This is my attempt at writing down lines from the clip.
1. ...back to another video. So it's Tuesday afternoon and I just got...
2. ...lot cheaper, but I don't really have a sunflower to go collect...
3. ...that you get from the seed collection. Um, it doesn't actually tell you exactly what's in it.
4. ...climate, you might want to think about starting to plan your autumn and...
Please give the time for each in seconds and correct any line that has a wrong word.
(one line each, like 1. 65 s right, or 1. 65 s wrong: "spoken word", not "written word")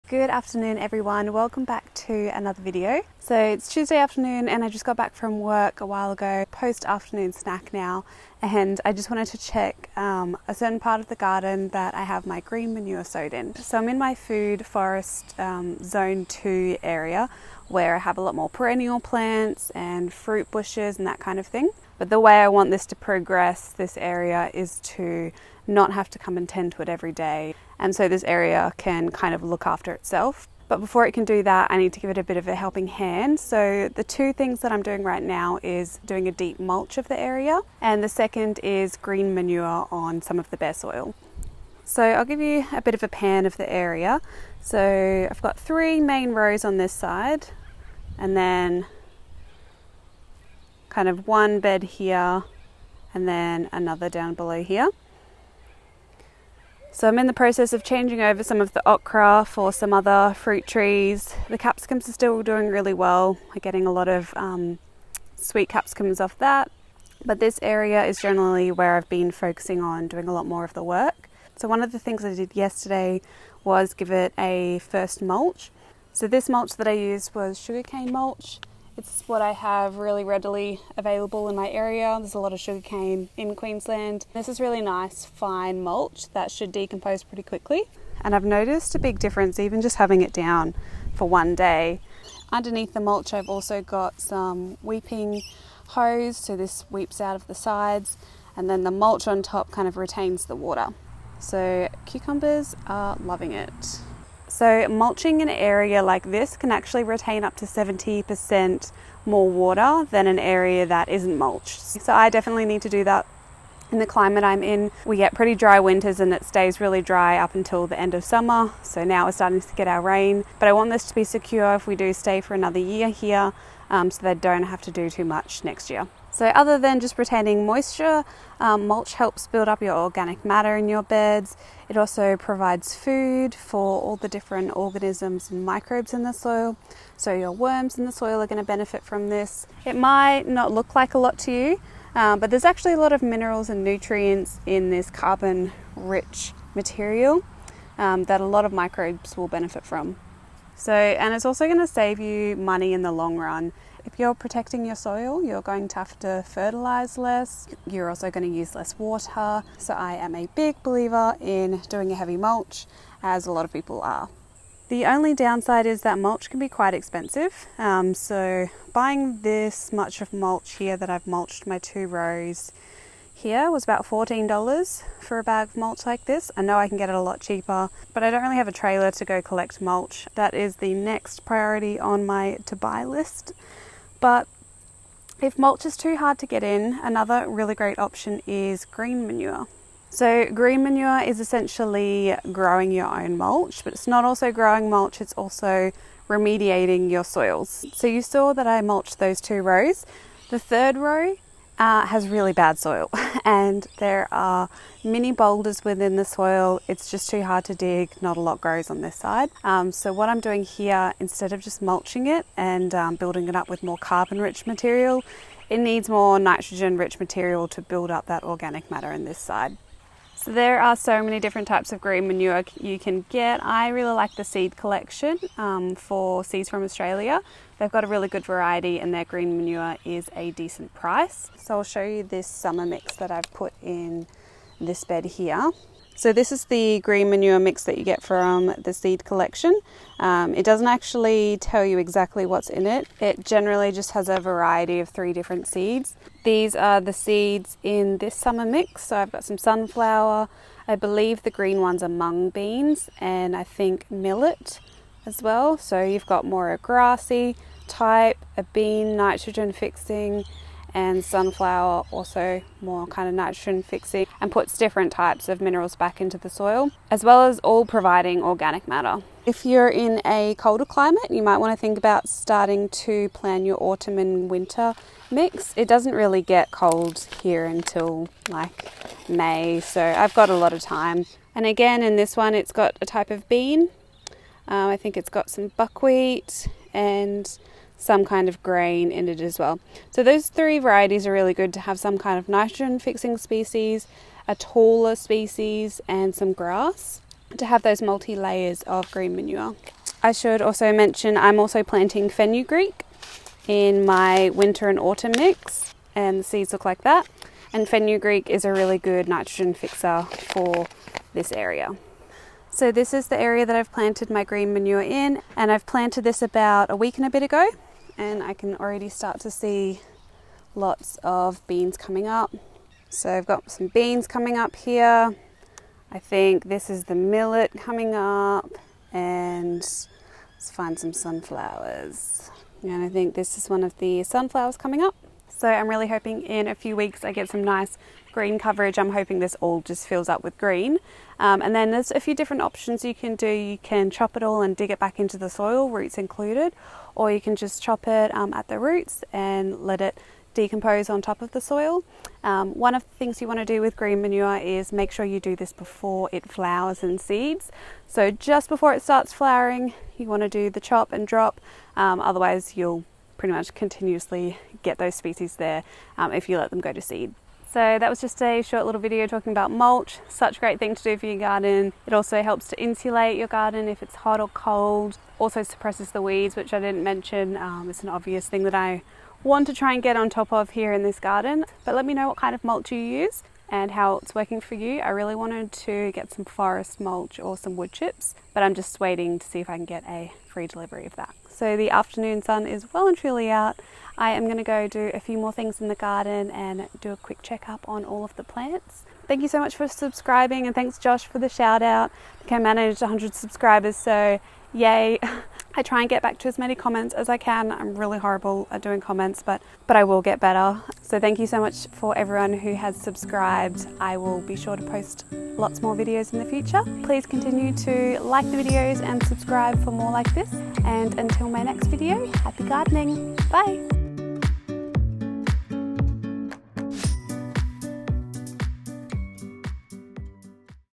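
1. 1 s right
2. 177 s wrong: "trailer", not "sunflower"
3. 237 s right
4. 270 s right.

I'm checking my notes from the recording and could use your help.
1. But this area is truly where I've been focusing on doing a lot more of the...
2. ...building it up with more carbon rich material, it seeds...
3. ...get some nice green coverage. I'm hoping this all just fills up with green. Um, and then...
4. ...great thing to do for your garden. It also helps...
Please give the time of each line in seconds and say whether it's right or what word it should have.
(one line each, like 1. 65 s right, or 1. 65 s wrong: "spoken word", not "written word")
1. 67 s wrong: "generally", not "truly"
2. 213 s wrong: "needs", not "seeds"
3. 337 s right
4. 370 s right.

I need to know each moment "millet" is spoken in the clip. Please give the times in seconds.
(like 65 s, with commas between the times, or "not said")
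254 s, 327 s.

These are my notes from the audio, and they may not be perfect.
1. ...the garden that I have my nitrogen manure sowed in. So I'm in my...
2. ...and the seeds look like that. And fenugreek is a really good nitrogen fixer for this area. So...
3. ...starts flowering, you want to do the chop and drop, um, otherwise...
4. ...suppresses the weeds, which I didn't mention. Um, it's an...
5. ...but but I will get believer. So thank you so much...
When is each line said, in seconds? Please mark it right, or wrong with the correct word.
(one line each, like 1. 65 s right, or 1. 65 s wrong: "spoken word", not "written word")
1. 11 s wrong: "green", not "nitrogen"
2. 306 s right
3. 359 s right
4. 375 s right
5. 409 s wrong: "better", not "believer".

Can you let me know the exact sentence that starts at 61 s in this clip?
The capsicums are still doing really well.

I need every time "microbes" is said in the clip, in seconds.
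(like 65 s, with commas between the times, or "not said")
135 s, 148 s.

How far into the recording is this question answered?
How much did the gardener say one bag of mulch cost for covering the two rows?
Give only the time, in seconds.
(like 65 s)
174 s.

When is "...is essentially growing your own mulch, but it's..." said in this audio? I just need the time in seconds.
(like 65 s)
191 s.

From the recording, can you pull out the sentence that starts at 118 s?
So now we're starting to get our rain.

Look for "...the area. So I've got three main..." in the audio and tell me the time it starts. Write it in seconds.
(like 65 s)
43 s.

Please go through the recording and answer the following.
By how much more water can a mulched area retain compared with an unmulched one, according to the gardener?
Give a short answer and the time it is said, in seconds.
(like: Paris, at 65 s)
Up to 70%, at 107 s.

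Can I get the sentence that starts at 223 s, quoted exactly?
I really like the seed collection um, for seeds from Australia.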